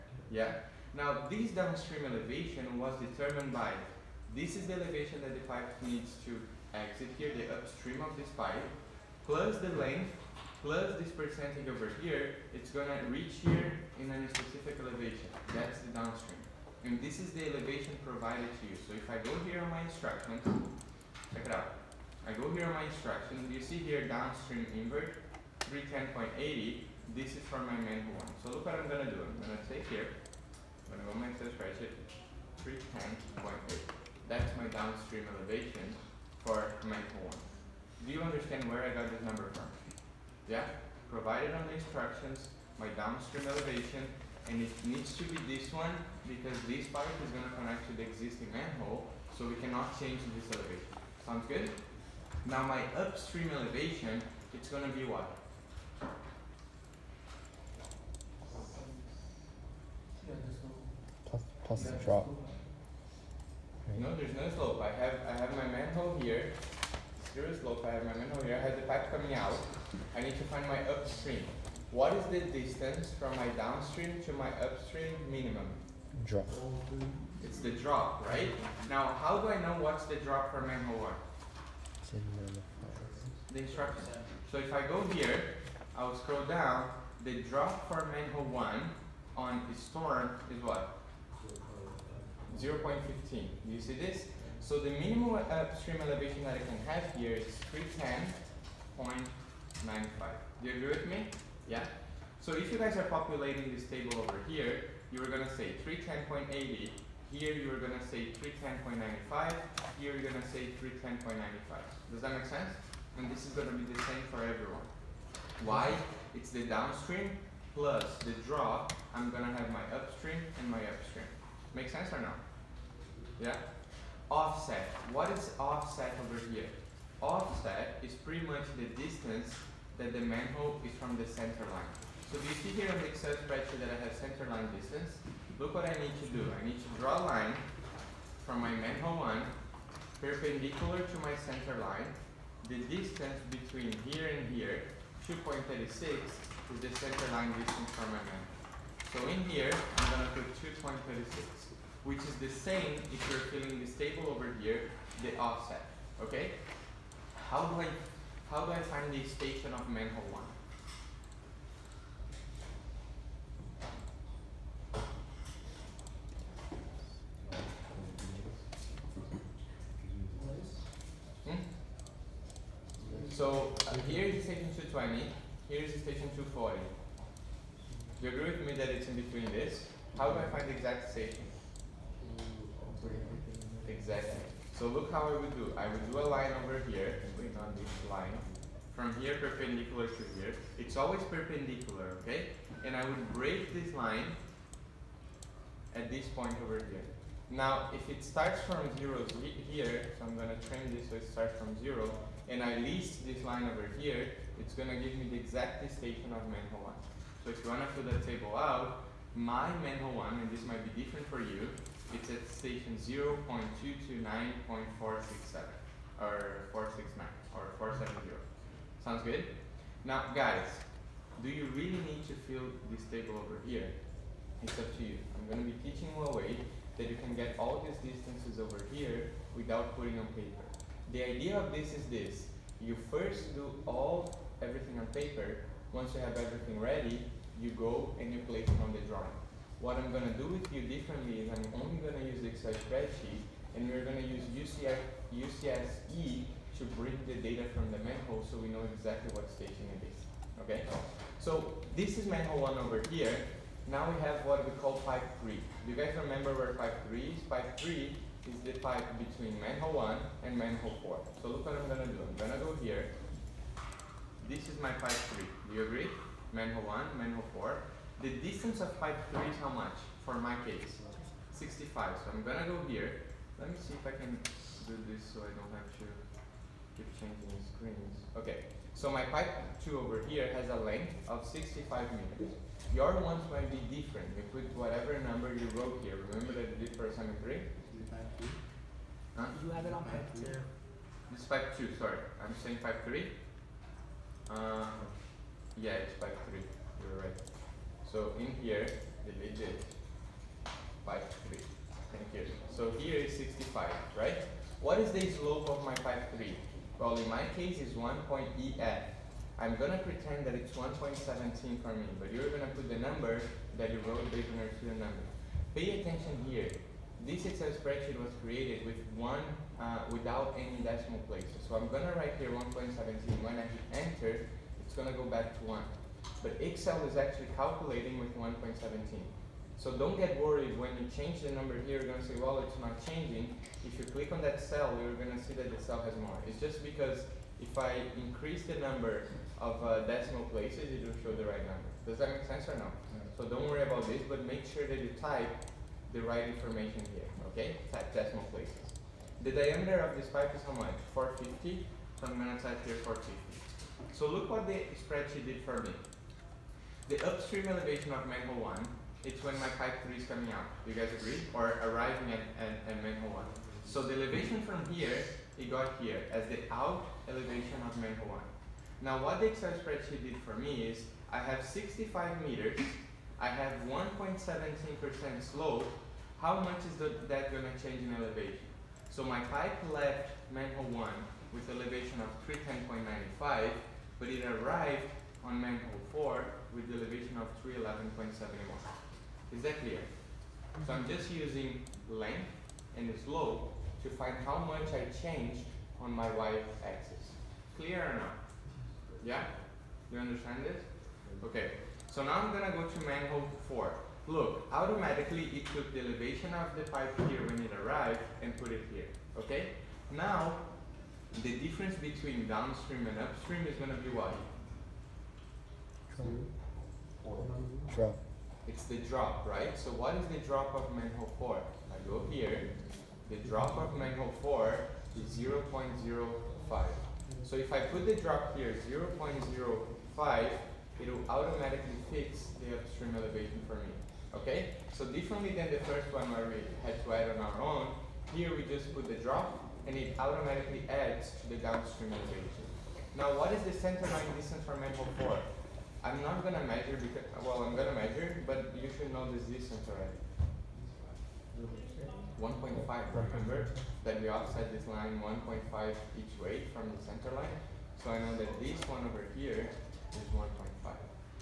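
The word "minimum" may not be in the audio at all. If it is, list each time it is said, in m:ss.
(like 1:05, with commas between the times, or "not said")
1:15, 1:34.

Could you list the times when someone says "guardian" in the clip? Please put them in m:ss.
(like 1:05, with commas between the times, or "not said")
not said.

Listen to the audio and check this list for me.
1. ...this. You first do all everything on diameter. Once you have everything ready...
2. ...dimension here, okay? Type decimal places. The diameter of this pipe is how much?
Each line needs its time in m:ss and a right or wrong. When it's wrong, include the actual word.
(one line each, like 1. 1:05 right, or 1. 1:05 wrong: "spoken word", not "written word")
1. 3:52 wrong: "paper", not "diameter"
2. 5:46 wrong: "information", not "dimension".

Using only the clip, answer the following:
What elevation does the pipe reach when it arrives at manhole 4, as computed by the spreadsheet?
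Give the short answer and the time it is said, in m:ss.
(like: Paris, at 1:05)
311.71, at 6:27.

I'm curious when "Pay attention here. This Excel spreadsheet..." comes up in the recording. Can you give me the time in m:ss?
5:15.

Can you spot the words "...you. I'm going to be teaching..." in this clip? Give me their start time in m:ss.
3:45.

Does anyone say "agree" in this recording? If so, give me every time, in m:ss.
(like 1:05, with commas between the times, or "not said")
1:40, 2:58, 4:25, 6:01.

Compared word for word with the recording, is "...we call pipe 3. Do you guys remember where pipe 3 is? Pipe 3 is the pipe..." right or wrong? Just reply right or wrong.
right.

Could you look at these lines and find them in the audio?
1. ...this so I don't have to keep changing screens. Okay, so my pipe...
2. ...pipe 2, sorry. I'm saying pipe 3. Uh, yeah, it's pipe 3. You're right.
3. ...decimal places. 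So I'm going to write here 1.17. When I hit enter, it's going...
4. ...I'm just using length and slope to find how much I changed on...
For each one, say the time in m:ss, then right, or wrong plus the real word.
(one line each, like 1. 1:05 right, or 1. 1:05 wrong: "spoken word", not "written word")
1. 4:35 right
2. 4:51 right
3. 5:20 right
4. 6:30 right.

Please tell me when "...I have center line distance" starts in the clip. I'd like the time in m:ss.
2:13.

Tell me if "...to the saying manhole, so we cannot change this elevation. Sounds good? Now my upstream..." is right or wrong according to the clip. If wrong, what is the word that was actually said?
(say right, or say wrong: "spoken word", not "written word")
wrong: "existing", not "saying".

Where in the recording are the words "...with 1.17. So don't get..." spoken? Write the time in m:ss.
5:28.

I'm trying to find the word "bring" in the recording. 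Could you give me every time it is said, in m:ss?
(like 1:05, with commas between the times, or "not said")
4:06.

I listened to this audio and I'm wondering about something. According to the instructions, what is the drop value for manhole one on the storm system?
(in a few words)
0.15.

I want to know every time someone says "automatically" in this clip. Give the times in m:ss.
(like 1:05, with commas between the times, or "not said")
6:44, 7:11, 7:20.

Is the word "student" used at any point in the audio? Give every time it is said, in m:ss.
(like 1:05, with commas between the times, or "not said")
5:14.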